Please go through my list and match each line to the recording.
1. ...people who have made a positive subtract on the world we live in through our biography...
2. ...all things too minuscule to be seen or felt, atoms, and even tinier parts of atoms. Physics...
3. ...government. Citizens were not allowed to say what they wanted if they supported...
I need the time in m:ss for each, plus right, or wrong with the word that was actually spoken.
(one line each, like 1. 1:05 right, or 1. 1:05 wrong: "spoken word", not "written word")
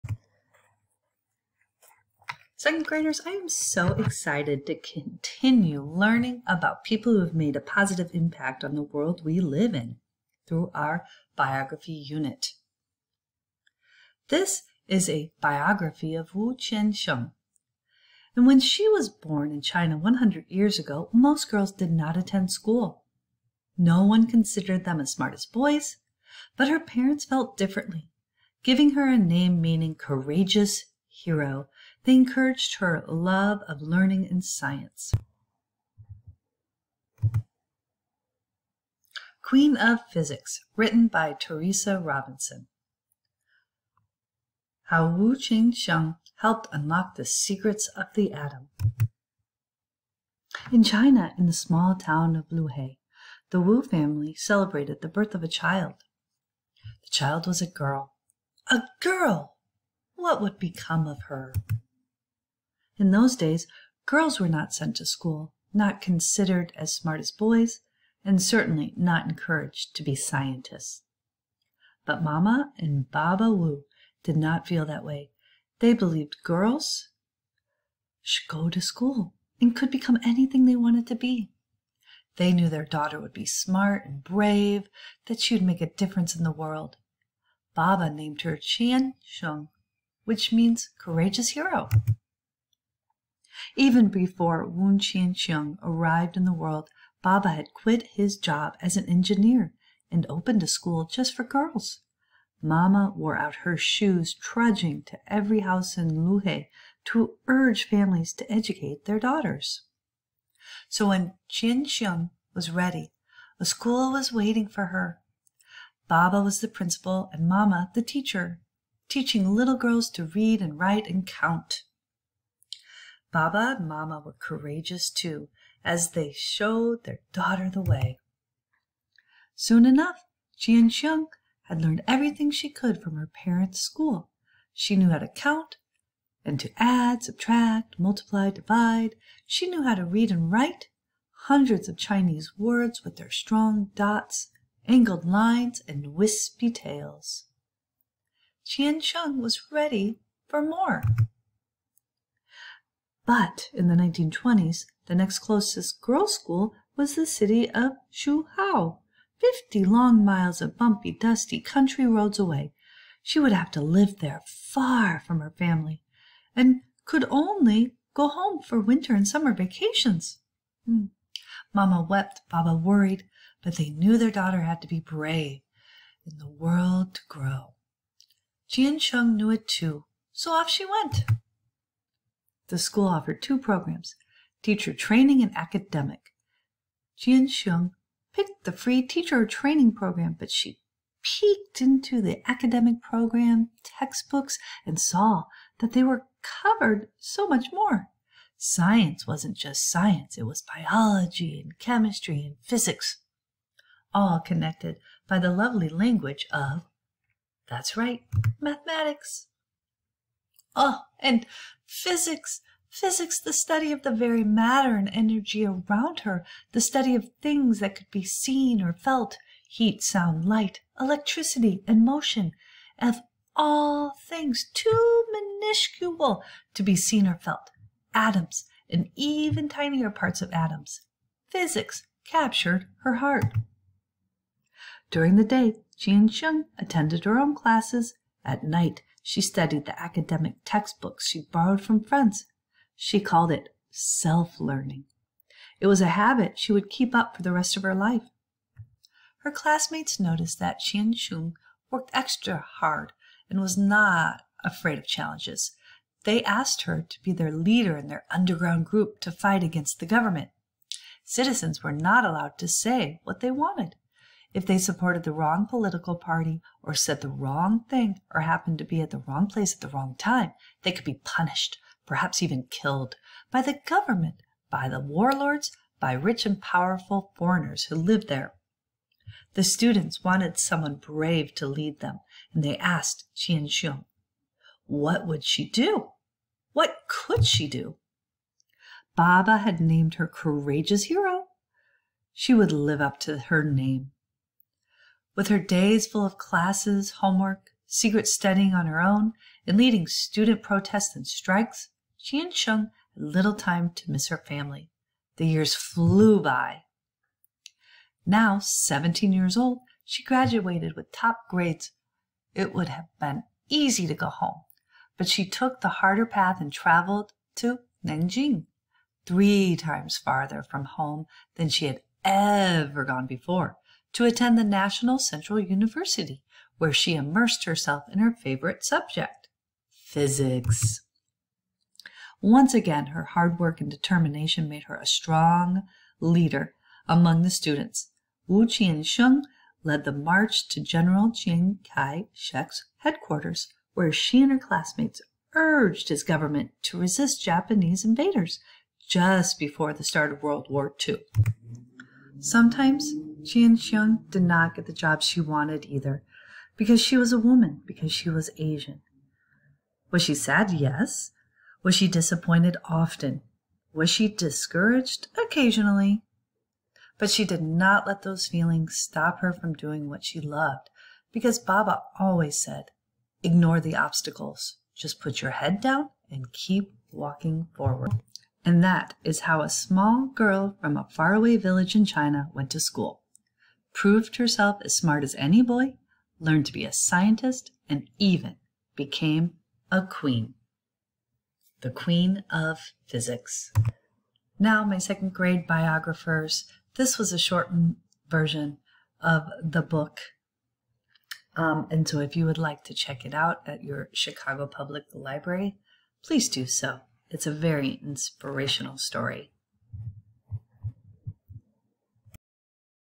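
1. 0:06 wrong: "impact", not "subtract"
2. 3:43 right
3. 4:20 right.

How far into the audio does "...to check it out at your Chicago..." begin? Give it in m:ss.
6:42.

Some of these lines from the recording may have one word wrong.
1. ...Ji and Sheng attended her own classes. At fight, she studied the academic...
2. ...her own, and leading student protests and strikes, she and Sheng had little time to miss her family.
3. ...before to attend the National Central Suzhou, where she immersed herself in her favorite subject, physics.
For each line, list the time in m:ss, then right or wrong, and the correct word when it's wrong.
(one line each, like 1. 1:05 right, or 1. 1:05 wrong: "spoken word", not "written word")
1. 3:55 wrong: "night", not "fight"
2. 4:58 right
3. 5:23 wrong: "University", not "Suzhou".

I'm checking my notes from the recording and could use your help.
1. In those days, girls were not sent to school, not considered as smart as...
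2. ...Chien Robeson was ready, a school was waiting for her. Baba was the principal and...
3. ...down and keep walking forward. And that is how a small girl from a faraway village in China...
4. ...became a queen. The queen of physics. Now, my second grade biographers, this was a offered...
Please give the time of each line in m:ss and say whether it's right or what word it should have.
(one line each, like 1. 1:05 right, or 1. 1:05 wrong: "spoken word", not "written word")
1. 1:03 right
2. 1:51 wrong: "Qianxiang", not "Robeson"
3. 6:15 right
4. 6:28 wrong: "shortened", not "offered".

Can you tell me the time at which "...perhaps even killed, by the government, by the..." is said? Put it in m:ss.
4:32.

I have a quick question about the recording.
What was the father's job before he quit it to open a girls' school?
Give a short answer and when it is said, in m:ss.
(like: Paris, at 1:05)
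Engineer, at 1:38.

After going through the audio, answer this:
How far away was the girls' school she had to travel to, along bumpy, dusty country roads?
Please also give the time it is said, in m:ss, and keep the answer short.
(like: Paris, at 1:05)
50 miles, at 2:39.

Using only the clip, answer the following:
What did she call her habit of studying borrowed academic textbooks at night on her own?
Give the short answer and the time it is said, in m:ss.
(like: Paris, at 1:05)
Self learning, at 4:03.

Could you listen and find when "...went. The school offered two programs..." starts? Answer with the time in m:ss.
3:00.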